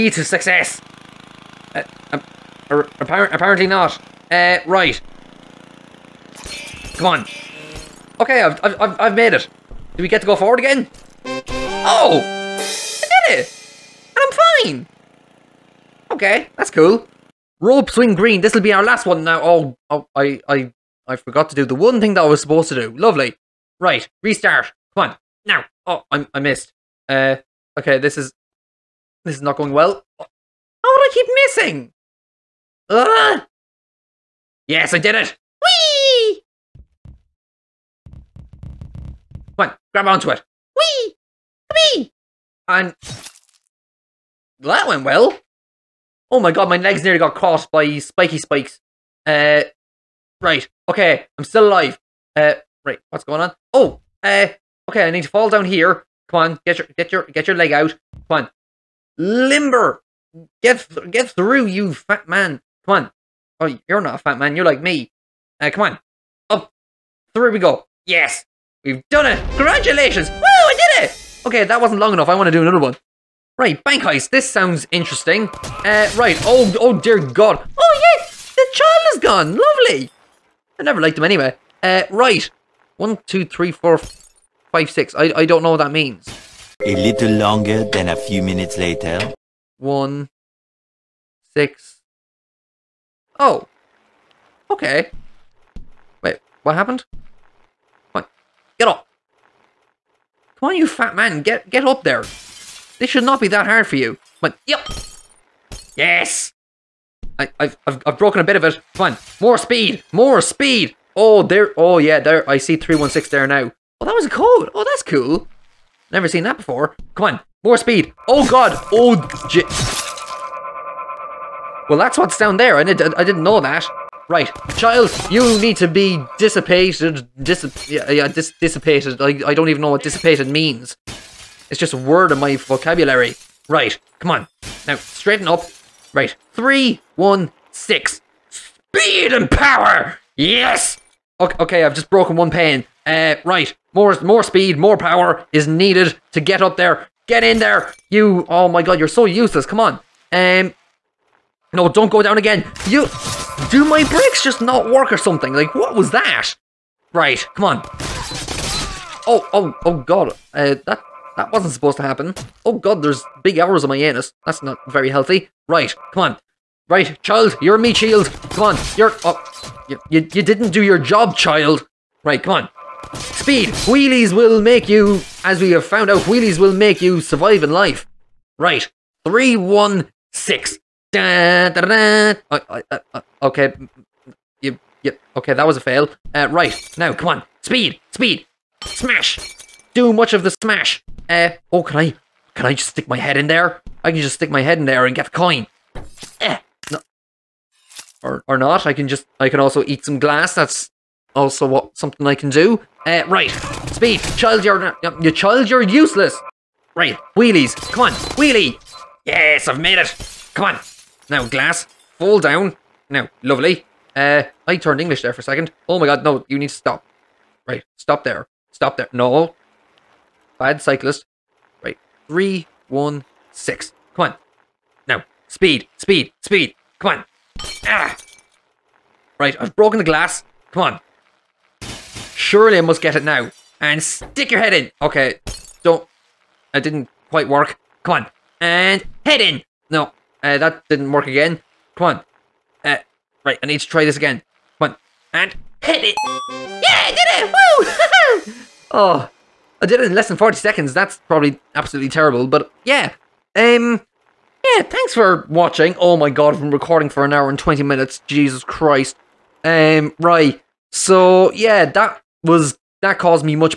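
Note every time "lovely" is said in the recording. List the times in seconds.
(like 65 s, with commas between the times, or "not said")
22 s, 79 s, 213 s.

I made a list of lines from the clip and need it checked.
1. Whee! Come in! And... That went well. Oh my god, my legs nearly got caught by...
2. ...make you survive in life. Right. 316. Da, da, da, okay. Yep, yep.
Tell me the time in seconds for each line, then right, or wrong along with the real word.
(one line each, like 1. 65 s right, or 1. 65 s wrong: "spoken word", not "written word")
1. 40 s right
2. 176 s right.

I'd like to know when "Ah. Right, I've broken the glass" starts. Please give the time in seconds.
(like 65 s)
227 s.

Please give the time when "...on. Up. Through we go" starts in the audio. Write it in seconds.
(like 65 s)
65 s.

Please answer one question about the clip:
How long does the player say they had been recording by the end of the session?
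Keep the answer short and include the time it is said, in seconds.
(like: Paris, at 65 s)
An hour and 20 minutes, at 257 s.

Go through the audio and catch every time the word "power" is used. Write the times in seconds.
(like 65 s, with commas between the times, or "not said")
139 s, 144 s.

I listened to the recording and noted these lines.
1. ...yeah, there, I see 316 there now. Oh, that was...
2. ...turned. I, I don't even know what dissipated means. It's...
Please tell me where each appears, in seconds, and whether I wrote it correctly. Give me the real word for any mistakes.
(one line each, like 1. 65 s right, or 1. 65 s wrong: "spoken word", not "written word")
1. 111 s right
2. 128 s wrong: "dissipated", not "turned".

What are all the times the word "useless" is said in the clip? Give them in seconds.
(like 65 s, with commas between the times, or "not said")
149 s, 205 s.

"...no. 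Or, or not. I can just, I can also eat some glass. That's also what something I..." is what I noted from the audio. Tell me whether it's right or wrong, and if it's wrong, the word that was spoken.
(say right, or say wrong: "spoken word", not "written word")
right.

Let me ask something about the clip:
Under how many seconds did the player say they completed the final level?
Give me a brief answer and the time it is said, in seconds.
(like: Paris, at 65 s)
40, at 250 s.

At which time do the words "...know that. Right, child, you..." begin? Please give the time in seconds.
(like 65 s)
123 s.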